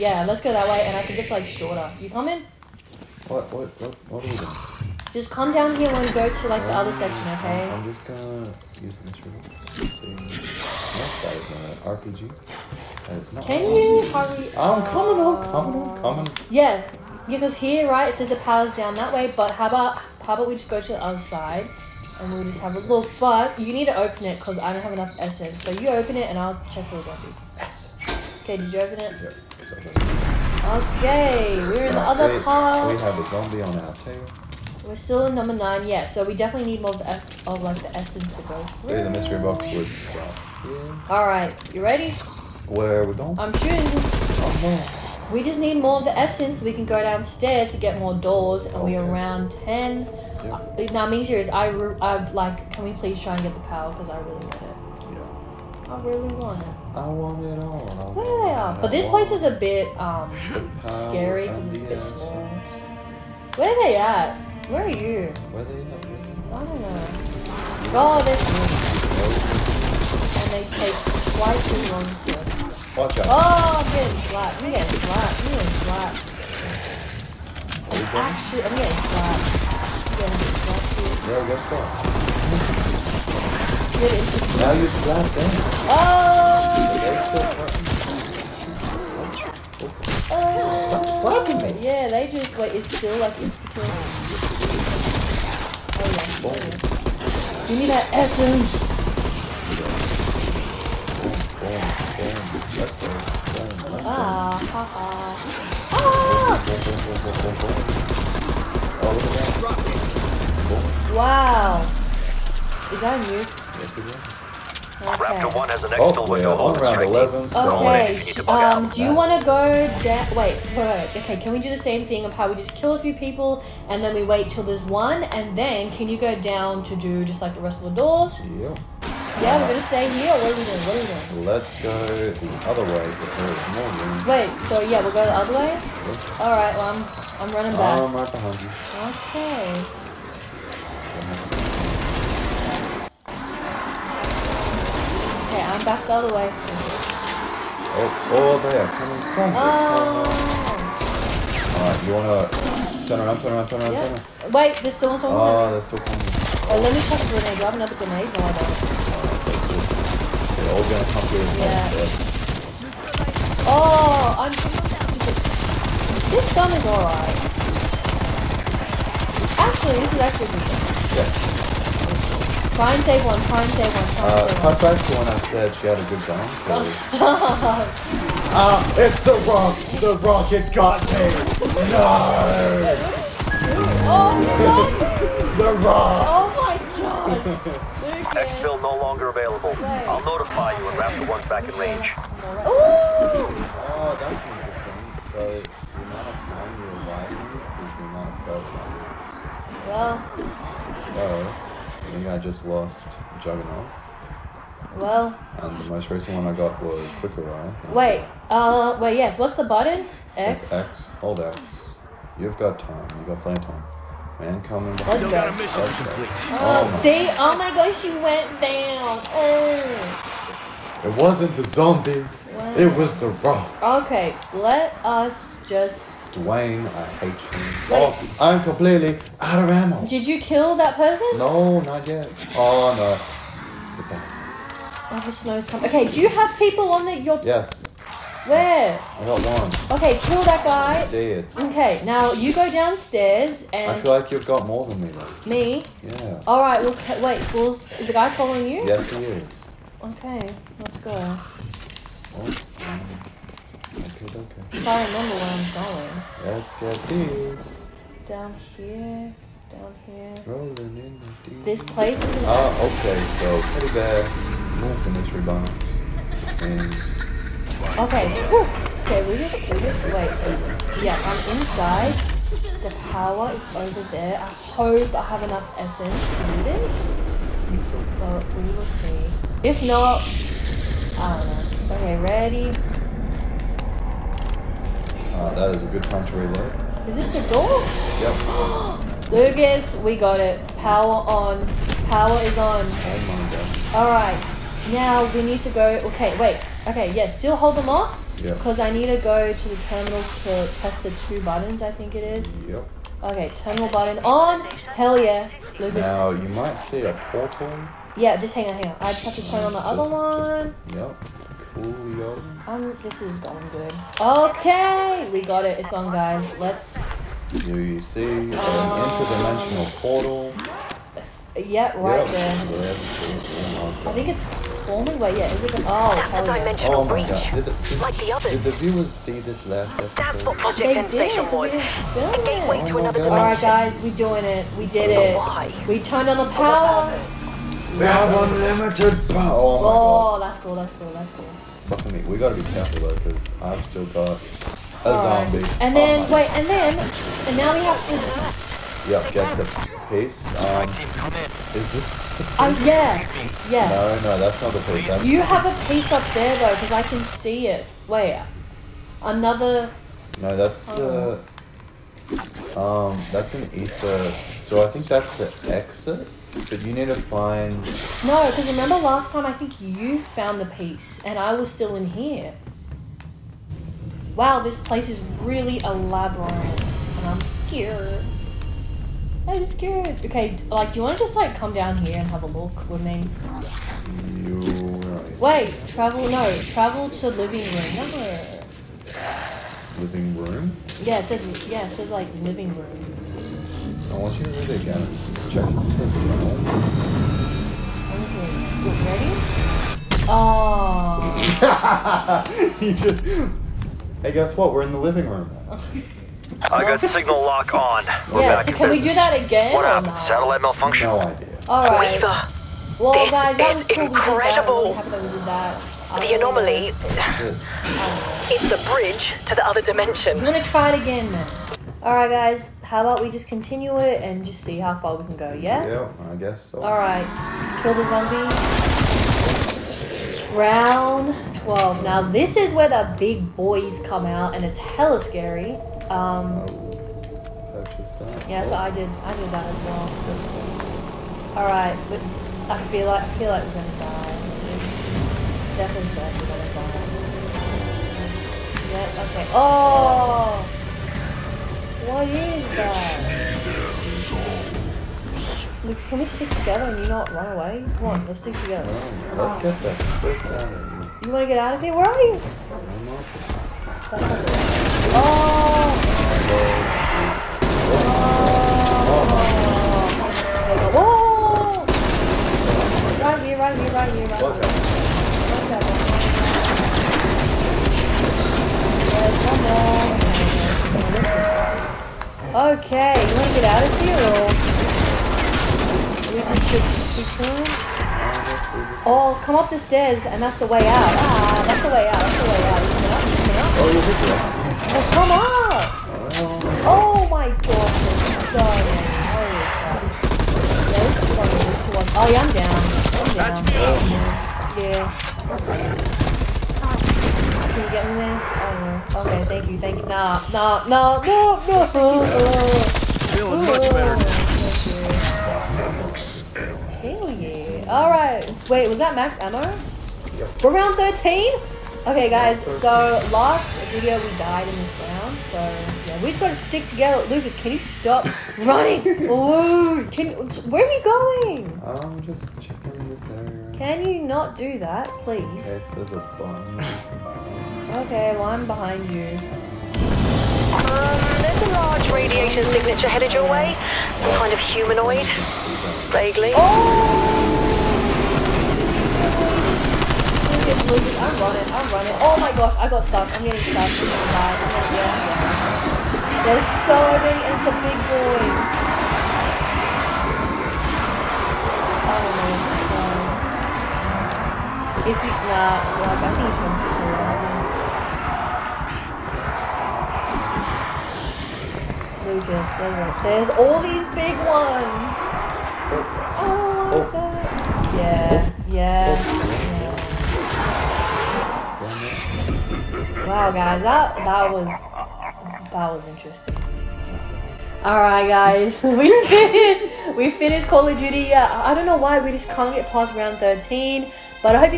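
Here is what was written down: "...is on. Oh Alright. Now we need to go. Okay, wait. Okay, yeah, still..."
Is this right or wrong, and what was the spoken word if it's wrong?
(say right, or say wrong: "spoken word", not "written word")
right.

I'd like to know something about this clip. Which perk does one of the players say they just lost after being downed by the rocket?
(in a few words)
Juggernaut.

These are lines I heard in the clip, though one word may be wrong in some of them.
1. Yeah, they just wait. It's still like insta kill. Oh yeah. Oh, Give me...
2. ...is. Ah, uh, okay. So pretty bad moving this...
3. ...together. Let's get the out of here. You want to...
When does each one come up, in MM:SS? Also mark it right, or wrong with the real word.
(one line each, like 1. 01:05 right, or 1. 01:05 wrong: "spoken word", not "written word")
1. 01:31 right
2. 04:22 right
3. 07:38 right.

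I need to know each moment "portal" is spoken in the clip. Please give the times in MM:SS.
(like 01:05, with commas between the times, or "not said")
05:07, 05:20.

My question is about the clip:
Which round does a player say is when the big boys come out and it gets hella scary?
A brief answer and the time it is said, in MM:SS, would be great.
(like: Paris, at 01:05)
Round 12, at 07:10.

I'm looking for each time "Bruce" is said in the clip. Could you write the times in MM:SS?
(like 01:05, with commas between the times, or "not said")
not said.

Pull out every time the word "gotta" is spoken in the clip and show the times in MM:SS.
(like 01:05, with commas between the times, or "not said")
05:42, 08:46.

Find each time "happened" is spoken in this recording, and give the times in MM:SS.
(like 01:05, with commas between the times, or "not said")
06:49.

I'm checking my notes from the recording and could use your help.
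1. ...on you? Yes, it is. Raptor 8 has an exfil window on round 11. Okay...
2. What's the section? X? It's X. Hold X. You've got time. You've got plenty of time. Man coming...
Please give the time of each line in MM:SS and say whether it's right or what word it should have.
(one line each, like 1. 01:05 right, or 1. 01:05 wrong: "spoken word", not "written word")
1. 01:53 wrong: "1", not "8"
2. 03:29 wrong: "button", not "section".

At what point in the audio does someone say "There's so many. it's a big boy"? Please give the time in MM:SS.
09:16.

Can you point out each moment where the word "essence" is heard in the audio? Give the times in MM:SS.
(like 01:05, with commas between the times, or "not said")
00:25, 00:37, 00:46, 01:38, 04:35.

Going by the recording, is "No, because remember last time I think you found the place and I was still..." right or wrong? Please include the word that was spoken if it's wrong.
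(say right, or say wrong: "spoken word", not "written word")
wrong: "piece", not "place".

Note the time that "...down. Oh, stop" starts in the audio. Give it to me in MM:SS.
02:56.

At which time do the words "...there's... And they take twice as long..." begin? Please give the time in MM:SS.
01:08.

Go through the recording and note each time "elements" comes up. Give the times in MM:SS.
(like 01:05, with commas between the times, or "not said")
not said.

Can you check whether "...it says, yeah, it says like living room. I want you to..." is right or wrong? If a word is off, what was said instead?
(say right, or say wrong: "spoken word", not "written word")
right.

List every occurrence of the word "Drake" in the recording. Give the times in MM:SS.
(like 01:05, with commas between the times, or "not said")
not said.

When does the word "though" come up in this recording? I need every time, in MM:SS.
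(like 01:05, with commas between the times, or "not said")
04:05, 05:43, 05:56.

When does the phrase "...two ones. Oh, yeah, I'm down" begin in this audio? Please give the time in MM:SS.
08:21.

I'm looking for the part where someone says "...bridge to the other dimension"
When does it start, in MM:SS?
06:58.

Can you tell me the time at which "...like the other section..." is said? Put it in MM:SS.
00:06.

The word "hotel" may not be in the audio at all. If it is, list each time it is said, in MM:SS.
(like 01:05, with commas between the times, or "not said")
not said.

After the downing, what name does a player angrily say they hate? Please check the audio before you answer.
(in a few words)
Dwayne.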